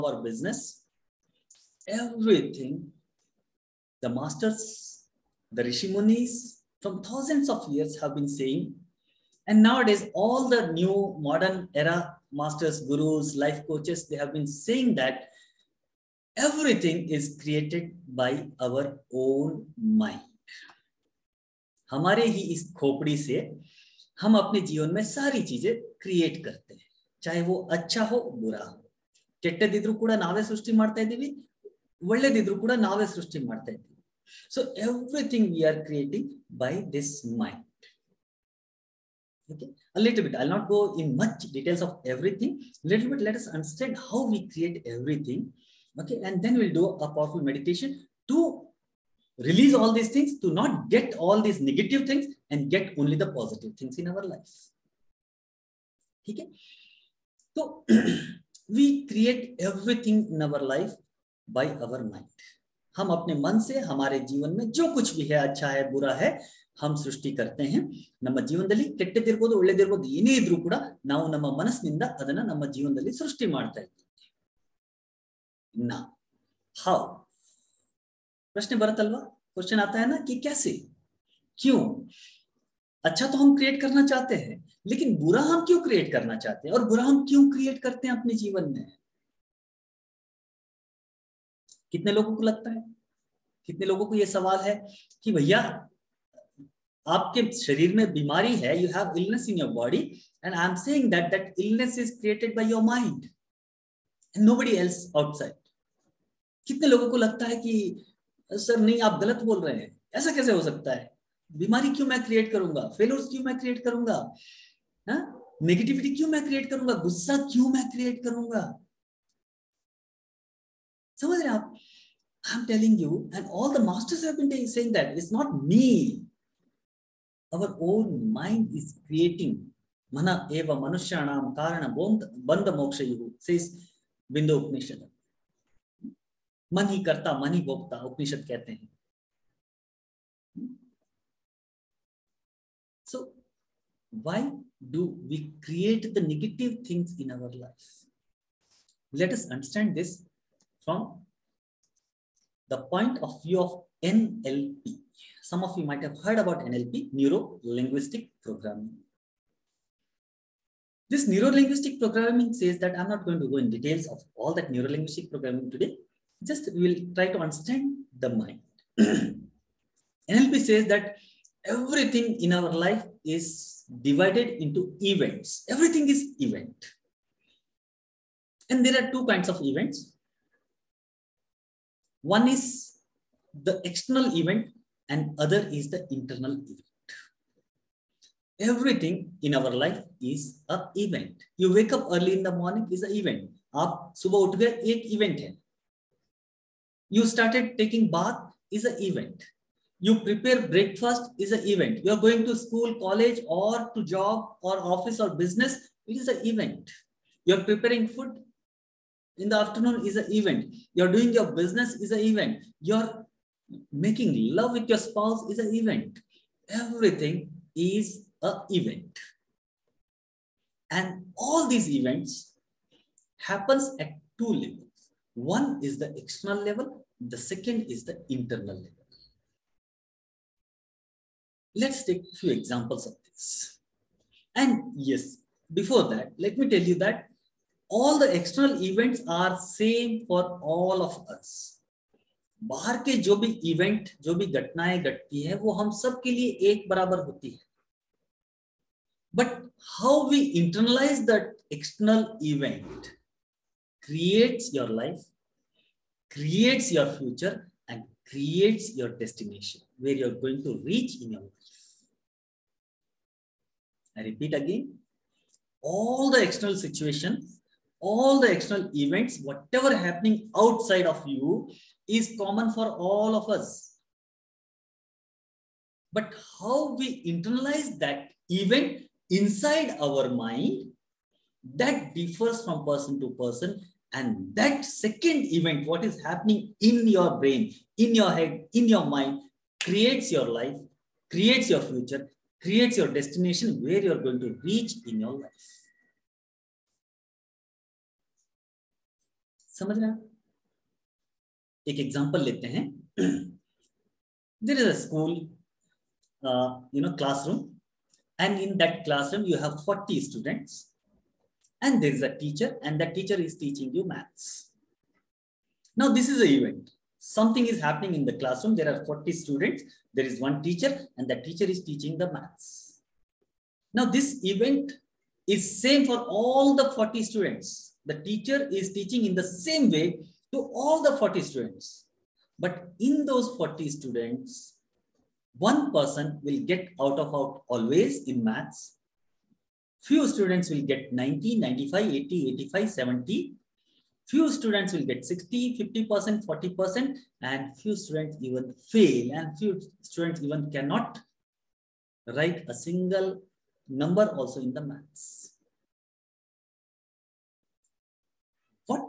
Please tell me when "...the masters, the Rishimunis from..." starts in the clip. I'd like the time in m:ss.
0:04.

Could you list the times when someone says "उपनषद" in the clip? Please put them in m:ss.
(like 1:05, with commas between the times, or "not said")
2:18.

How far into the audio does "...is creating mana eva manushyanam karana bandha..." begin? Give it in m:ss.
2:08.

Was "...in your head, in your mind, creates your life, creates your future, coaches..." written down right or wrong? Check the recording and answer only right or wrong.
wrong.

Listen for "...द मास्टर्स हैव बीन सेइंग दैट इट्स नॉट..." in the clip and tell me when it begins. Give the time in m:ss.
2:03.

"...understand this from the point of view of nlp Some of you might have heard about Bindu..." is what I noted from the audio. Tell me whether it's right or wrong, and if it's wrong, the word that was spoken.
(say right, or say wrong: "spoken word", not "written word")
wrong: "NLP", not "Bindu".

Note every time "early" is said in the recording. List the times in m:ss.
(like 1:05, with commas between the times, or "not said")
3:12.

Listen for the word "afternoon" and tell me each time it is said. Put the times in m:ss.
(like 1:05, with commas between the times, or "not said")
3:29.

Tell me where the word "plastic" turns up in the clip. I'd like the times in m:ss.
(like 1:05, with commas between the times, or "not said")
not said.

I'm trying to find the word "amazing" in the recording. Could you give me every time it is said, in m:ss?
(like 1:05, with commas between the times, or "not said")
not said.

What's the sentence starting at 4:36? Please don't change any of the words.
But how we internalize that event inside our mind, that differs from person to person.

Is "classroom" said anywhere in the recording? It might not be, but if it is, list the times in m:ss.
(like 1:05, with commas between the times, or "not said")
5:09, 5:18.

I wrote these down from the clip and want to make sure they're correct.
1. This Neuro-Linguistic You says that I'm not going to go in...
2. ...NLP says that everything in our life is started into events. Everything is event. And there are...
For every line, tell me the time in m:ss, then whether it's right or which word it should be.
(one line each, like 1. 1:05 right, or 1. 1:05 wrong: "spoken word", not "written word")
1. 2:41 wrong: "Programming", not "You"
2. 2:49 wrong: "divided", not "started".